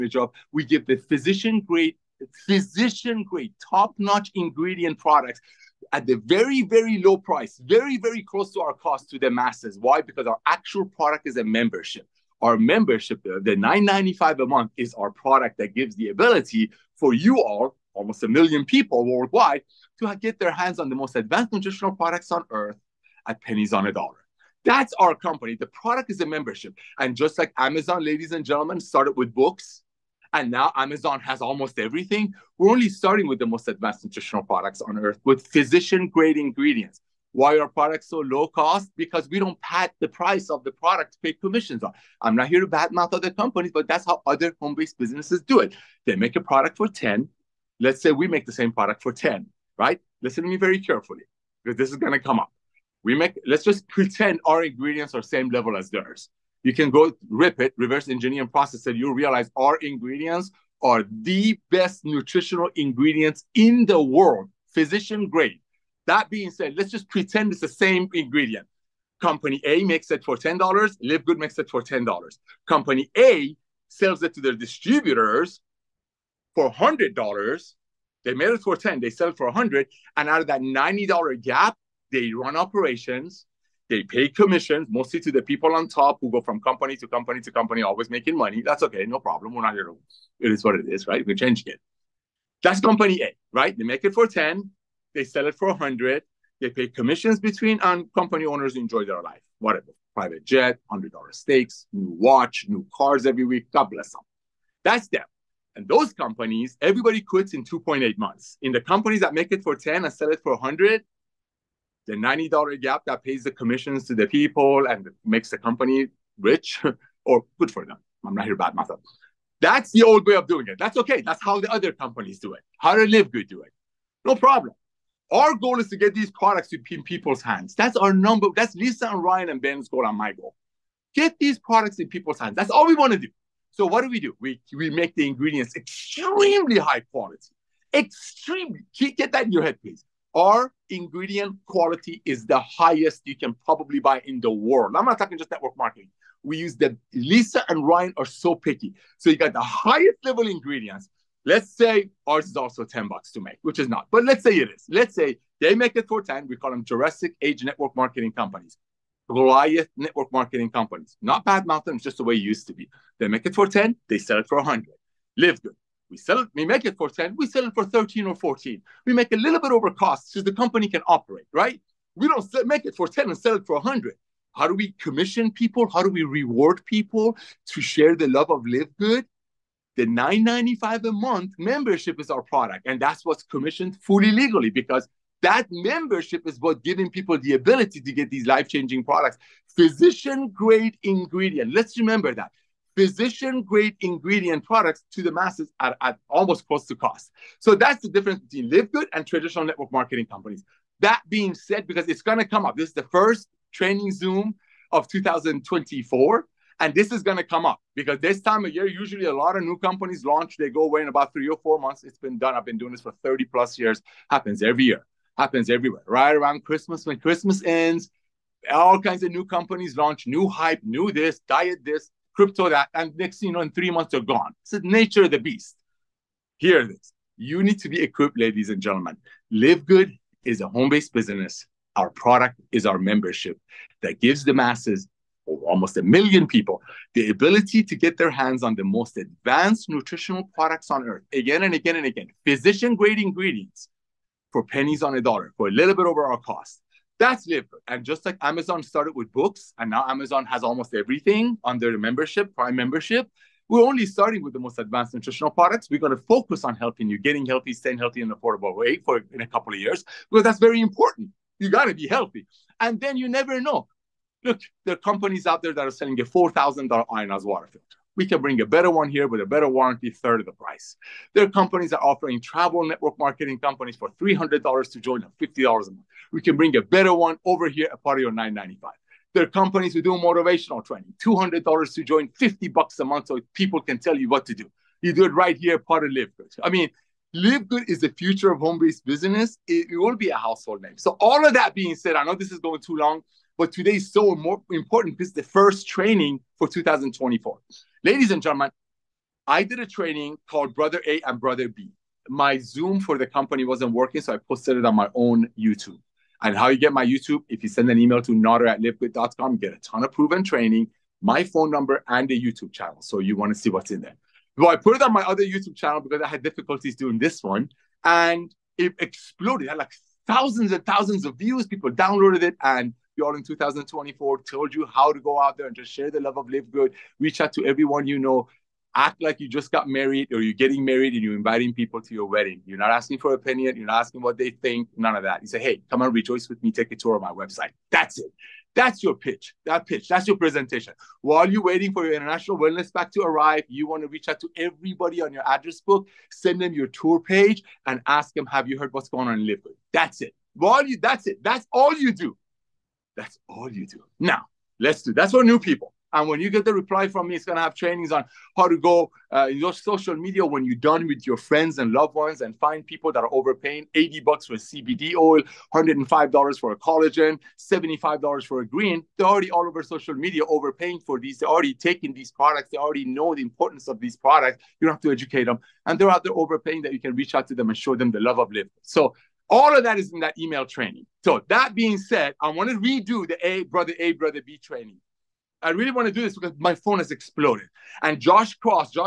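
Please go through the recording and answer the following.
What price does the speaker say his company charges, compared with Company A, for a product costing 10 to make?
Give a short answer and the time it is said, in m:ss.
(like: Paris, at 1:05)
13 or 14, at 2:47.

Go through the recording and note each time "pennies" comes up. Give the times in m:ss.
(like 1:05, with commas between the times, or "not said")
0:23, 4:04.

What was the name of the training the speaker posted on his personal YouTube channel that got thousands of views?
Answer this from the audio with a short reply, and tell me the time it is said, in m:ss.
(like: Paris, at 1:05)
Brother A and Brother B, at 5:00.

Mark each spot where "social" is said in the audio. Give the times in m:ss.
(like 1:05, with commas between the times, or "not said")
5:59, 6:09.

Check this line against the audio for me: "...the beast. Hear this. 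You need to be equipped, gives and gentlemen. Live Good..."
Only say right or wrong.
wrong.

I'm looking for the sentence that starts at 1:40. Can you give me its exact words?
Private jet, $100 stakes, new watch, new cars every week.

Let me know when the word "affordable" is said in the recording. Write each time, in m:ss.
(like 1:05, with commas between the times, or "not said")
4:18.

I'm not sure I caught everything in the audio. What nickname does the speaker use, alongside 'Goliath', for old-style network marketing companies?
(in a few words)
Jurassic Age.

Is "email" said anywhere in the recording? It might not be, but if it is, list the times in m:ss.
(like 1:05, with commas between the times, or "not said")
5:07, 6:20.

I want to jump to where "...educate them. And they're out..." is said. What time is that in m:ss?
6:15.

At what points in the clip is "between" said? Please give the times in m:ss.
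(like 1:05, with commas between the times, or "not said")
1:37, 3:18.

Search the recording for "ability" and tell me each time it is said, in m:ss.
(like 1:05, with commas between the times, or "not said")
0:16, 3:07, 3:57.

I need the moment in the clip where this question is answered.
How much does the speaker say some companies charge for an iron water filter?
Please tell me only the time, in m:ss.
4:26.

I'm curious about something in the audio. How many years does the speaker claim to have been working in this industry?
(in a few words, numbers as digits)
30 plus years.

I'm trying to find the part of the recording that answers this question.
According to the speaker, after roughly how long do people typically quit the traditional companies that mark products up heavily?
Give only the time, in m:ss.
1:47.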